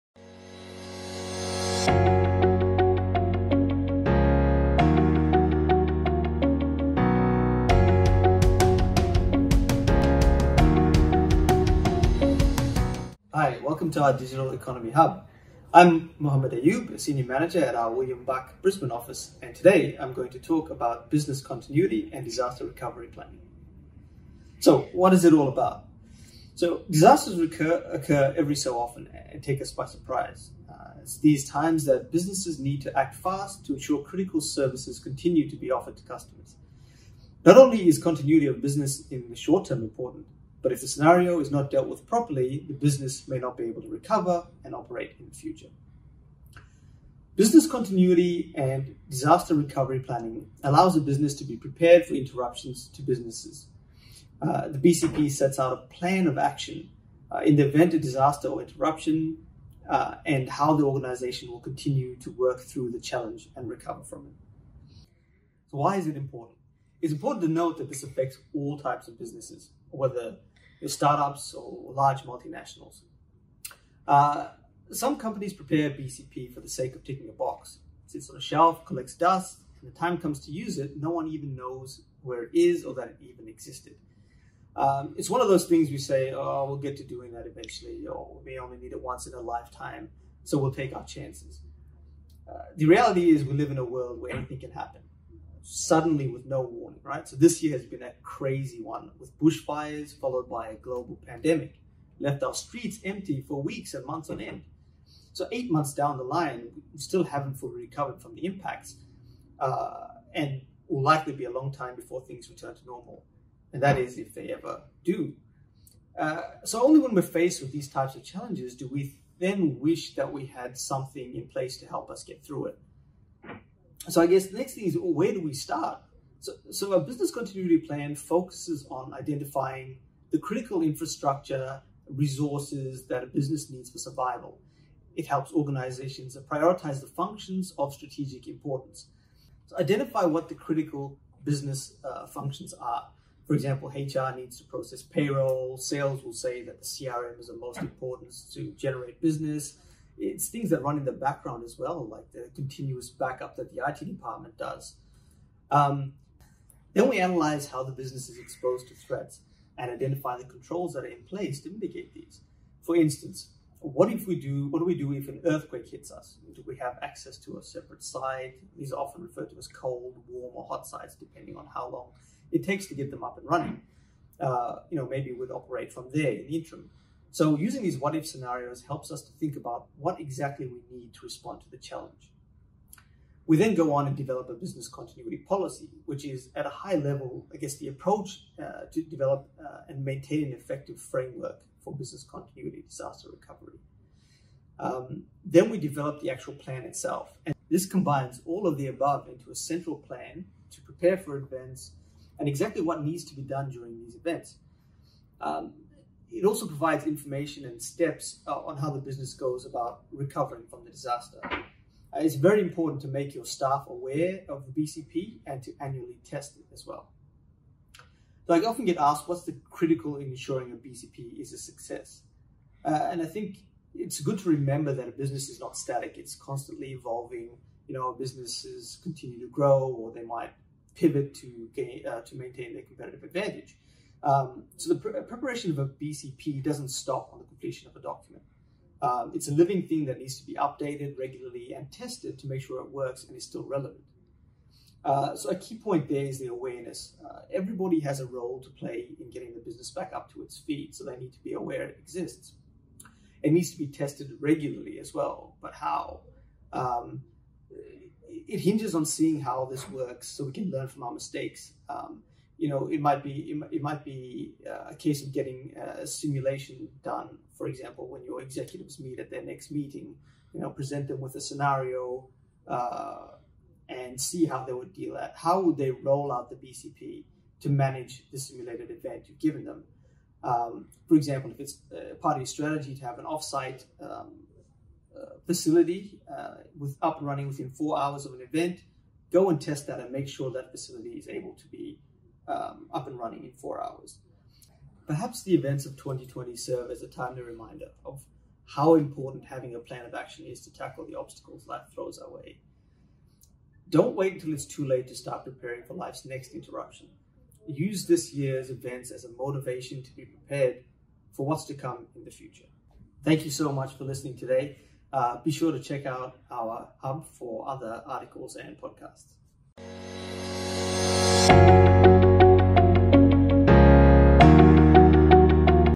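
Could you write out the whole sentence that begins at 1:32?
Uh, the reality is we live in a world where anything can happen suddenly with no warning, right?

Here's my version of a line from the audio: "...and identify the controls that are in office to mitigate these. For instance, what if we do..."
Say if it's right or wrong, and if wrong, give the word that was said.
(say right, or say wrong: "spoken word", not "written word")
wrong: "place", not "office".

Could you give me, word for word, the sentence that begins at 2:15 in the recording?
It helps organizations prioritize the functions of strategic importance.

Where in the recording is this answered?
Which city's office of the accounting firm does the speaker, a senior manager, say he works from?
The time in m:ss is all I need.
0:18.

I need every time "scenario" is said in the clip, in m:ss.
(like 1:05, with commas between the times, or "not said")
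0:40, 2:58, 4:31.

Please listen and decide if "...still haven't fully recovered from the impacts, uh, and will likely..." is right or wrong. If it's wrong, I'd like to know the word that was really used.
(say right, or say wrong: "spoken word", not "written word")
right.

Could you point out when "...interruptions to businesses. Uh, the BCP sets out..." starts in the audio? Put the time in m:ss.
0:52.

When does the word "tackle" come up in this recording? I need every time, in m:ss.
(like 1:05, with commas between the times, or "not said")
5:00.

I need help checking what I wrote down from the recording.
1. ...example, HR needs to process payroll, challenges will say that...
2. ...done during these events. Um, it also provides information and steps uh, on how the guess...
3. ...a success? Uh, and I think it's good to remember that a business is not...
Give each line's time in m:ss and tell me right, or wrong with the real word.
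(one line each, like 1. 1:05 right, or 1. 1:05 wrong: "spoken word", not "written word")
1. 2:23 wrong: "sales", not "challenges"
2. 3:23 wrong: "business", not "guess"
3. 3:41 right.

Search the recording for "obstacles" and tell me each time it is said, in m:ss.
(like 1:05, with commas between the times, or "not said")
5:01.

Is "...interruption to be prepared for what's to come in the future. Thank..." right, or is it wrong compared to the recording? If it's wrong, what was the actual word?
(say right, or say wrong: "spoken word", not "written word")
wrong: "motivation", not "interruption".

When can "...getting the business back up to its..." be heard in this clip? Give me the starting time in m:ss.
4:09.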